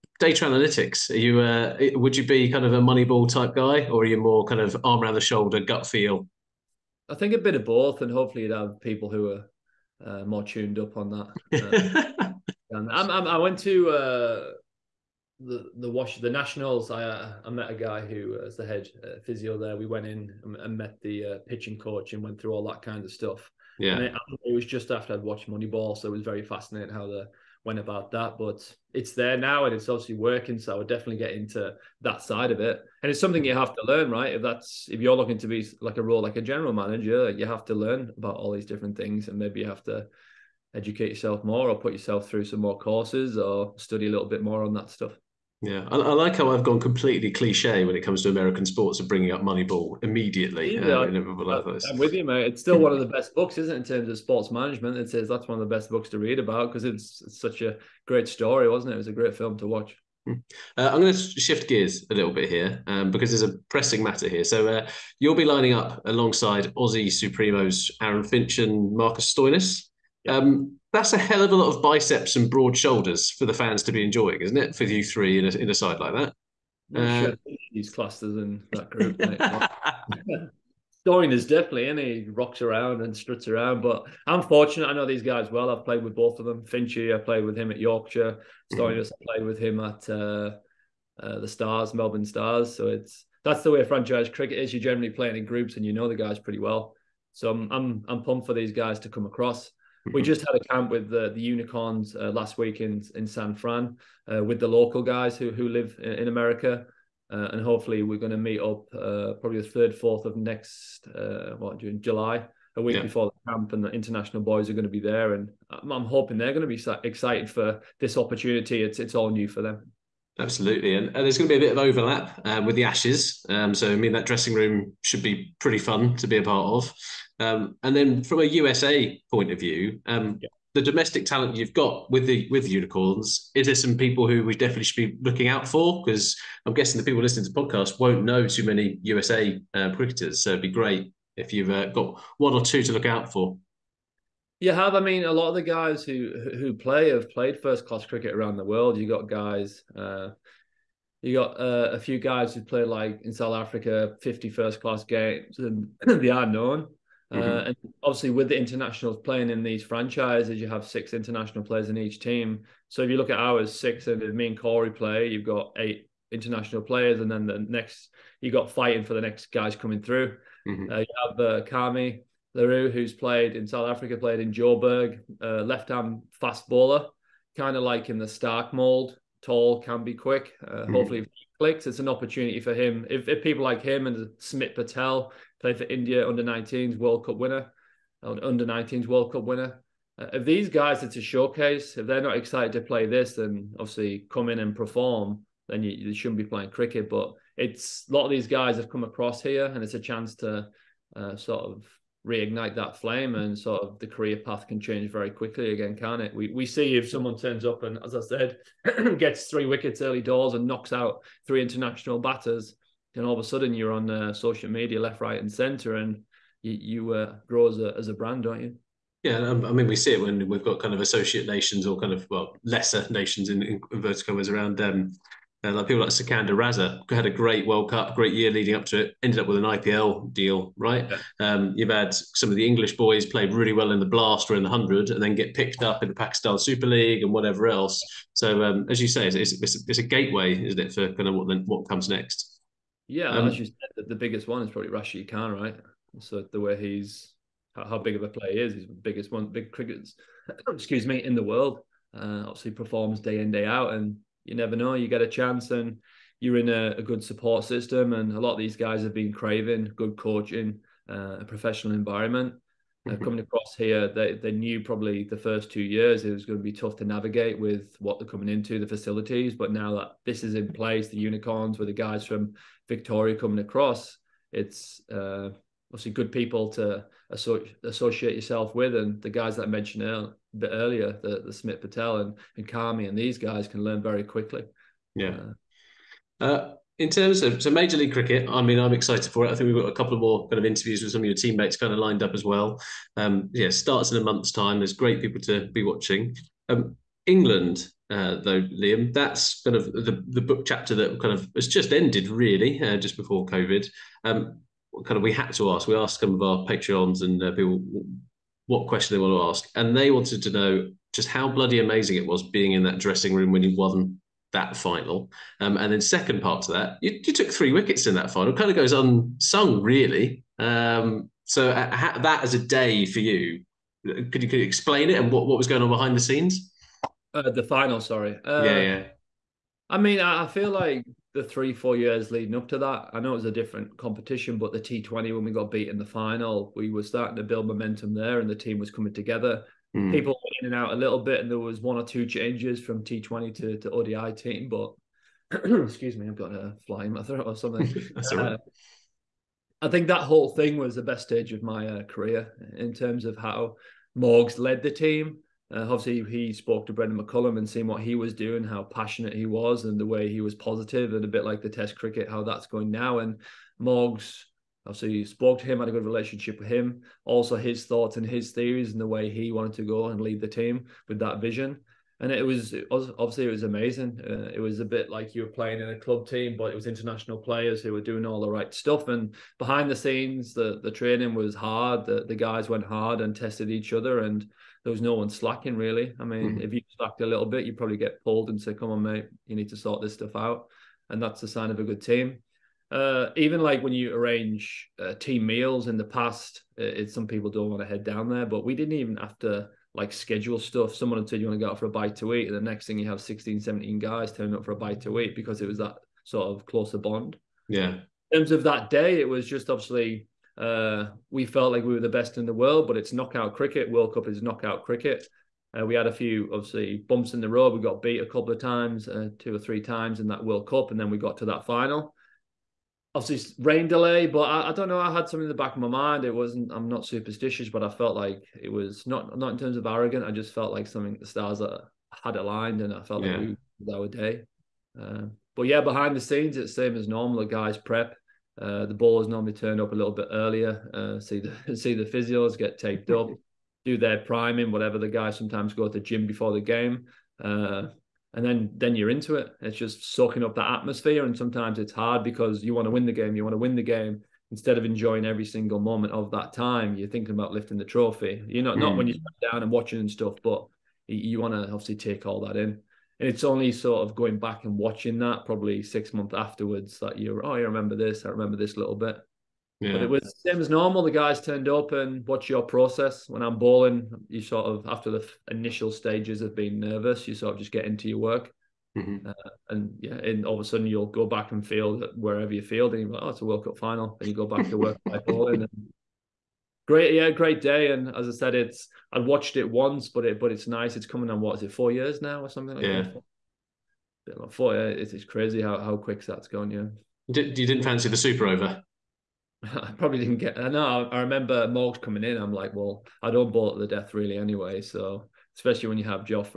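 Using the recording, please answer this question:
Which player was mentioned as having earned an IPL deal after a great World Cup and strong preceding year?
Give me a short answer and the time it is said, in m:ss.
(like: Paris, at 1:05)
Sikander Raza, at 3:46.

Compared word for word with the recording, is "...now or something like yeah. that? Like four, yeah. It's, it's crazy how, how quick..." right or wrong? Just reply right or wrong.
right.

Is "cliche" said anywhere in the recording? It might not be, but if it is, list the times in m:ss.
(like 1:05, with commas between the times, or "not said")
0:47.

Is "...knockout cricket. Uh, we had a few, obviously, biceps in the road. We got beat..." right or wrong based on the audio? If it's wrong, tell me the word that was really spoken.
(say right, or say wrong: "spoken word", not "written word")
wrong: "bumps", not "biceps".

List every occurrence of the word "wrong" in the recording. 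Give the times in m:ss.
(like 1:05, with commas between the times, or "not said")
not said.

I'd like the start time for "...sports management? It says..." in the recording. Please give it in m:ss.
0:54.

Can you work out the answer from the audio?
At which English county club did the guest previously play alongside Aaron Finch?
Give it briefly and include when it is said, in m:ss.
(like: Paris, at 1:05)
Yorkshire, at 1:27.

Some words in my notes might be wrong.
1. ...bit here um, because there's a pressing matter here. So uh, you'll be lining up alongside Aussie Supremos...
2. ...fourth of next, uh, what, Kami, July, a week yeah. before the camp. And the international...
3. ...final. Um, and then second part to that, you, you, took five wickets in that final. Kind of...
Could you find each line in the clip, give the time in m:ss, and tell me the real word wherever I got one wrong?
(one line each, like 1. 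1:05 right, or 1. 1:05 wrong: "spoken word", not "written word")
1. 1:02 right
2. 1:49 wrong: "June", not "Kami"
3. 5:14 wrong: "three", not "five".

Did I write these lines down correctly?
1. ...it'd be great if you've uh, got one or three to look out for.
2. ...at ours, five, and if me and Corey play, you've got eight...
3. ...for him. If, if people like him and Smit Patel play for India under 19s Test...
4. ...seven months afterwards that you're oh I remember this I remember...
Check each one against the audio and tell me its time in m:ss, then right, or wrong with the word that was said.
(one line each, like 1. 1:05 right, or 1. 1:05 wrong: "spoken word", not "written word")
1. 2:20 wrong: "two", not "three"
2. 2:43 wrong: "six", not "five"
3. 3:02 wrong: "World", not "Test"
4. 7:45 wrong: "six", not "seven".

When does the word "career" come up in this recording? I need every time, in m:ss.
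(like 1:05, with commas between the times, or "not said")
3:24, 5:52.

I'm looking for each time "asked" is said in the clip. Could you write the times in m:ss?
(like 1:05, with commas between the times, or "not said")
5:05.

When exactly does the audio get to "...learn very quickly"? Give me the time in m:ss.
4:43.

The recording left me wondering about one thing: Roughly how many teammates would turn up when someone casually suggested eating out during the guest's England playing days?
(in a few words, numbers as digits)
16 or 17.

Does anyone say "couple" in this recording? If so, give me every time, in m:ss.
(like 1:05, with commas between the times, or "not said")
4:49, 6:58.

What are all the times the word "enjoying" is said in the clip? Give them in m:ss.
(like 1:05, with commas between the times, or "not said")
1:14, 7:34.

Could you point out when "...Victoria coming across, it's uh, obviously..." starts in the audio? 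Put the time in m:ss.
4:32.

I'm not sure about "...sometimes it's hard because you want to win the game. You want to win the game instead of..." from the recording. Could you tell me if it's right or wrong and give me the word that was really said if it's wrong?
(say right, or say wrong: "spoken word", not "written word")
right.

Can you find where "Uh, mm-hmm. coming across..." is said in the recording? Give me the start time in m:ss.
4:23.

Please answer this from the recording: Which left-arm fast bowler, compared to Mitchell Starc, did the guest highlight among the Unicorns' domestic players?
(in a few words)
Kami Larue.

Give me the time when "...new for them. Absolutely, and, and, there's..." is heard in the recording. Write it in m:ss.
1:59.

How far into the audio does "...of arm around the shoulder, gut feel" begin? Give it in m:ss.
0:04.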